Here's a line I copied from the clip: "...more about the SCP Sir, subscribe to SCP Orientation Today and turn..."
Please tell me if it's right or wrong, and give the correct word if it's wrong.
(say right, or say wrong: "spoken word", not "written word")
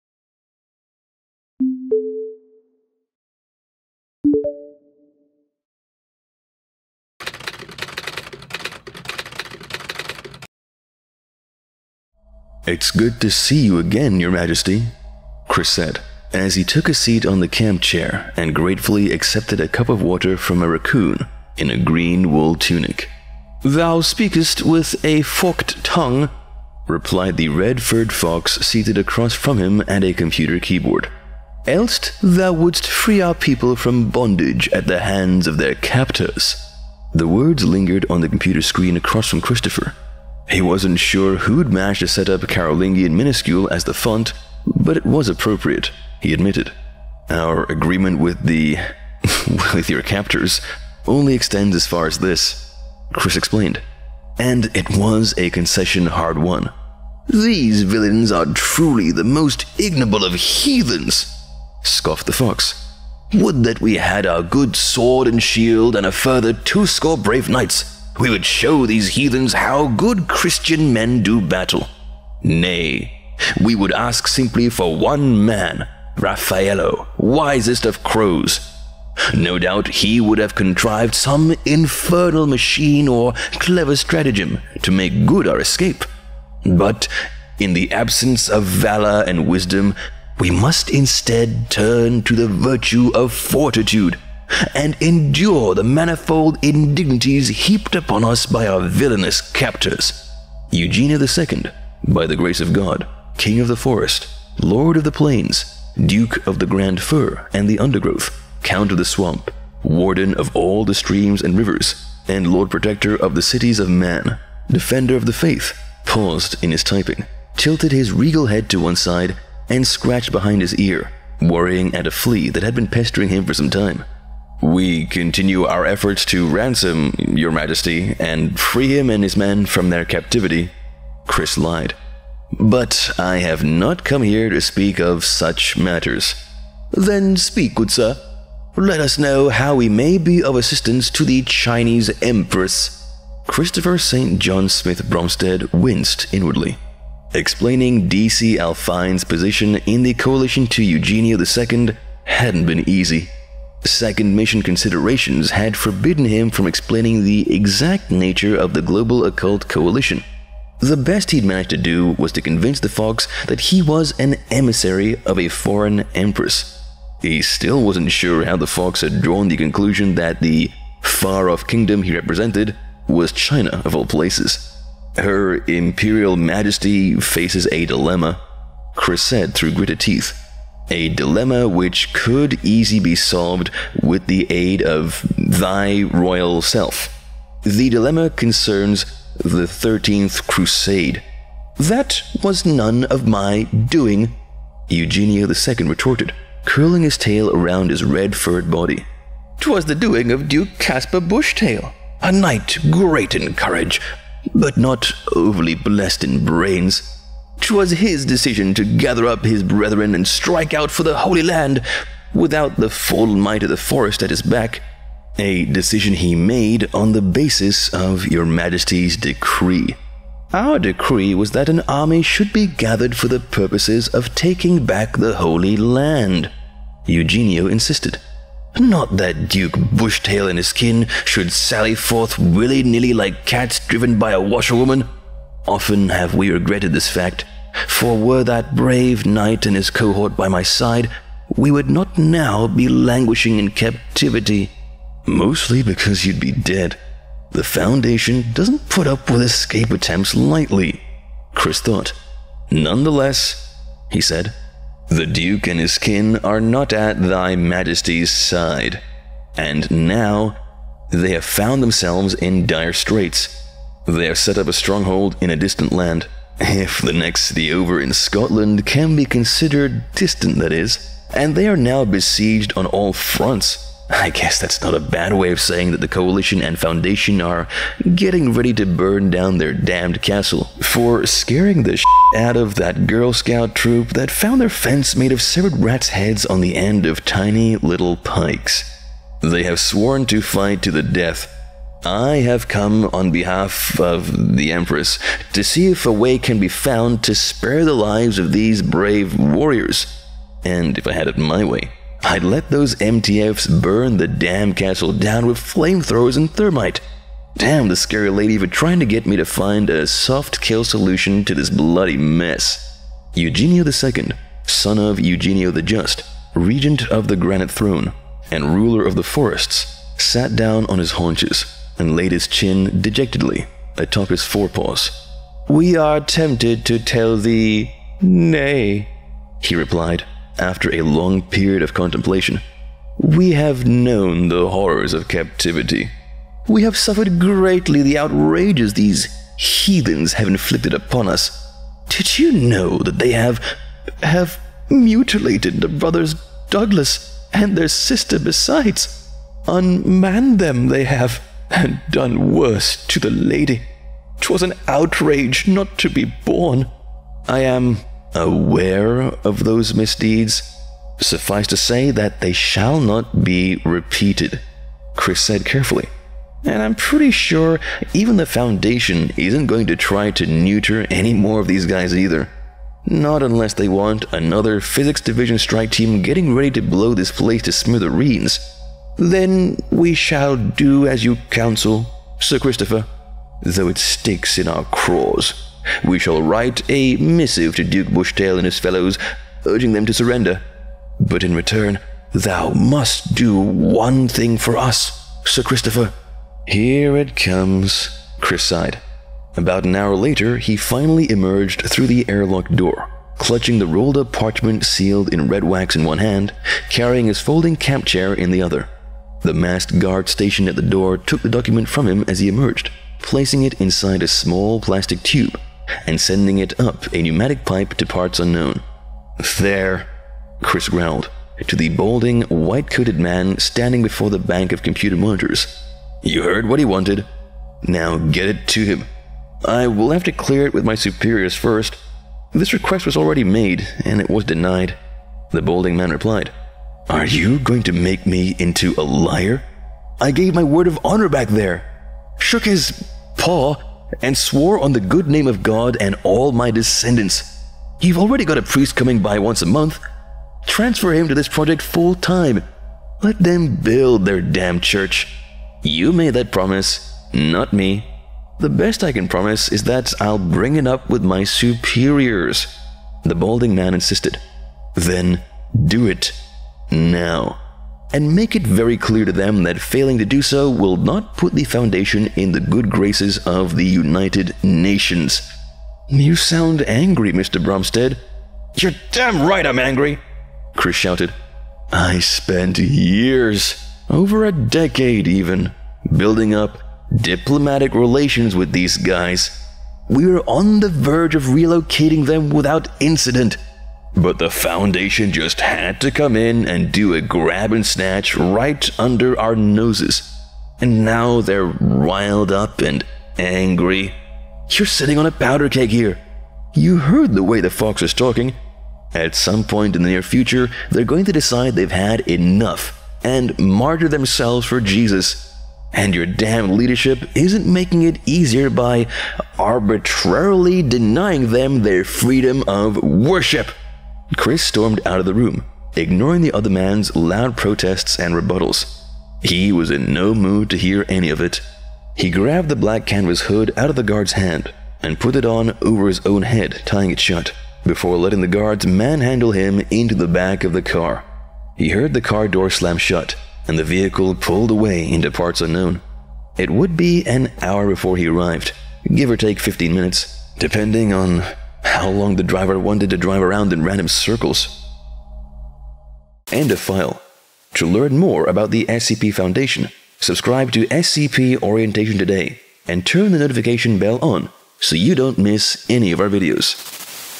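wrong: "Foundation", not "Sir".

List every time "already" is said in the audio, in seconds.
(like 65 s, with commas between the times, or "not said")
433 s, 448 s.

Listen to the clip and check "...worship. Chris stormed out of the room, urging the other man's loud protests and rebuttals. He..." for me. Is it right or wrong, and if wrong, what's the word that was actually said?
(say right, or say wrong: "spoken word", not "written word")
wrong: "ignoring", not "urging".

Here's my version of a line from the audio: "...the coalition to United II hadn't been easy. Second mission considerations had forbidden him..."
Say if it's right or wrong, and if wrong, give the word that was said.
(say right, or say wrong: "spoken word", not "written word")
wrong: "Eugenio", not "United".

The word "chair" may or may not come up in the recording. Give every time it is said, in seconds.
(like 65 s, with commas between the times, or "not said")
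17 s, 408 s.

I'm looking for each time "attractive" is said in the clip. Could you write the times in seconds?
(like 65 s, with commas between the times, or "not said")
not said.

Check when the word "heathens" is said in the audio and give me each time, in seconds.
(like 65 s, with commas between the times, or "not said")
60 s, 69 s, 339 s.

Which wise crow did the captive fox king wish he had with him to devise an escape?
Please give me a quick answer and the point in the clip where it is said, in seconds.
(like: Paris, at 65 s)
Raffaello, at 76 s.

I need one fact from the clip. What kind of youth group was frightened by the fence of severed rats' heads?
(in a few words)
Girl Scout troop.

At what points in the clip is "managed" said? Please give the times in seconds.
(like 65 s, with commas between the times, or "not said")
41 s, 161 s.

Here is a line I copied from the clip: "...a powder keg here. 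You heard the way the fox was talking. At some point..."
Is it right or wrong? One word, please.
right.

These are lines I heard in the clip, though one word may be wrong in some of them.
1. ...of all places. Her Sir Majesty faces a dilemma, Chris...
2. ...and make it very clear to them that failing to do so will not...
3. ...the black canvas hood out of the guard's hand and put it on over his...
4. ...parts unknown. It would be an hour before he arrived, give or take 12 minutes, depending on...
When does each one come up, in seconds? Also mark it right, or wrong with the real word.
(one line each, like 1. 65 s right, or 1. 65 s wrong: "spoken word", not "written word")
1. 173 s wrong: "Imperial", not "Sir"
2. 468 s right
3. 532 s right
4. 545 s wrong: "15", not "12".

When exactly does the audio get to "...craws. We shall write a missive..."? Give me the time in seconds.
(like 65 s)
384 s.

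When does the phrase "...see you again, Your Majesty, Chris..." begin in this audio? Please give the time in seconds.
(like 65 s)
13 s.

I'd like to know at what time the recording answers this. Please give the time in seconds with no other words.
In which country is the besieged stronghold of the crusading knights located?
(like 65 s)
268 s.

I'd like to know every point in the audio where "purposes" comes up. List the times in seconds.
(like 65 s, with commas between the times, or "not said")
223 s.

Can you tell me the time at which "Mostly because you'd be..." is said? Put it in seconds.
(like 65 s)
245 s.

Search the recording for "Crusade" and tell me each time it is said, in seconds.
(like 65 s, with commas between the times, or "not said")
190 s.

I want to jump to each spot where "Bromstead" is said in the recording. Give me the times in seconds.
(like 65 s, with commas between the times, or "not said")
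145 s, 477 s.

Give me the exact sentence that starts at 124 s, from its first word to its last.
We continue our efforts to ransom Your Majesty and free him and his men from their captivity.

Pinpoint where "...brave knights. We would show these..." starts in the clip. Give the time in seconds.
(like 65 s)
67 s.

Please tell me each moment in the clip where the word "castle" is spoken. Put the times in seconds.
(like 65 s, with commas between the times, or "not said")
280 s, 304 s.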